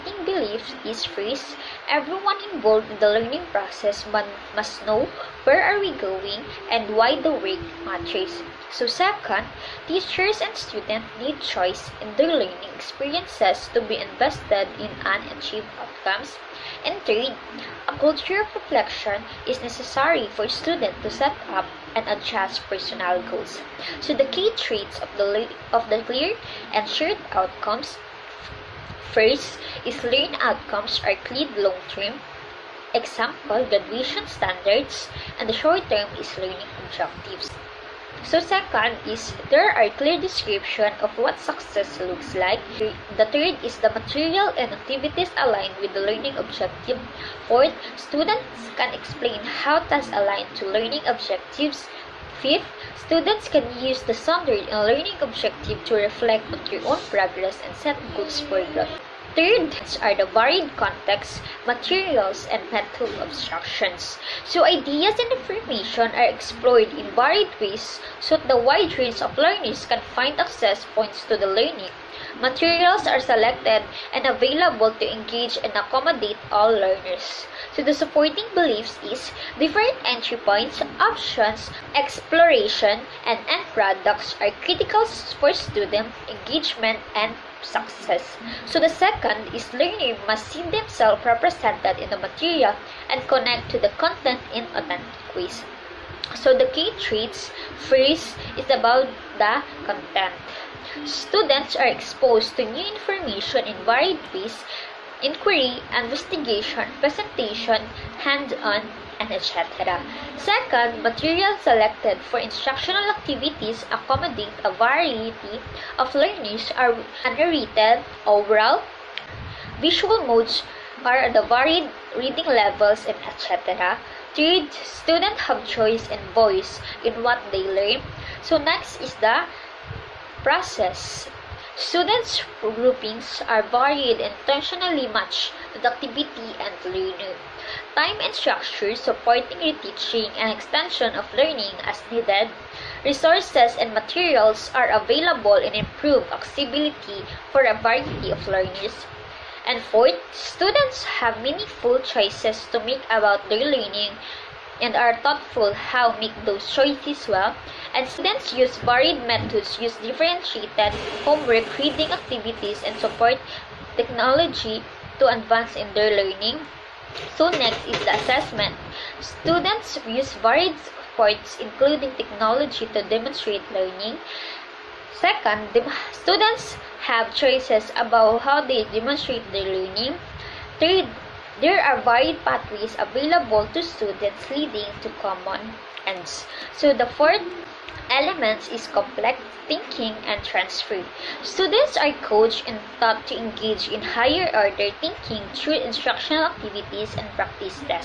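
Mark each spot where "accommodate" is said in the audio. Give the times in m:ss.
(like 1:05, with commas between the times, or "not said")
1:15, 1:53.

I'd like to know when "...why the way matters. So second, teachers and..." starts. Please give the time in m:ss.
0:06.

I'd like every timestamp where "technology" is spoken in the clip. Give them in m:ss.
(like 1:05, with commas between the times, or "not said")
2:43, 2:52.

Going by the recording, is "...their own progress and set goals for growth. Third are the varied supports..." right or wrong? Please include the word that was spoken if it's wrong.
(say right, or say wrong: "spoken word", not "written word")
wrong: "contexts", not "supports".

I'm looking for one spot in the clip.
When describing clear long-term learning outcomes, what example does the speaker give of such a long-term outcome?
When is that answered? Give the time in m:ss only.
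0:33.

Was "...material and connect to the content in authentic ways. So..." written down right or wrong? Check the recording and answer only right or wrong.
right.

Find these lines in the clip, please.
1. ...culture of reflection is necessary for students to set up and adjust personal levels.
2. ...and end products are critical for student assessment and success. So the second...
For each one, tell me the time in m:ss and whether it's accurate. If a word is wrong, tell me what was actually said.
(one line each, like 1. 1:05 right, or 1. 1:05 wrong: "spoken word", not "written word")
1. 0:17 wrong: "goals", not "levels"
2. 1:23 wrong: "engagement", not "assessment".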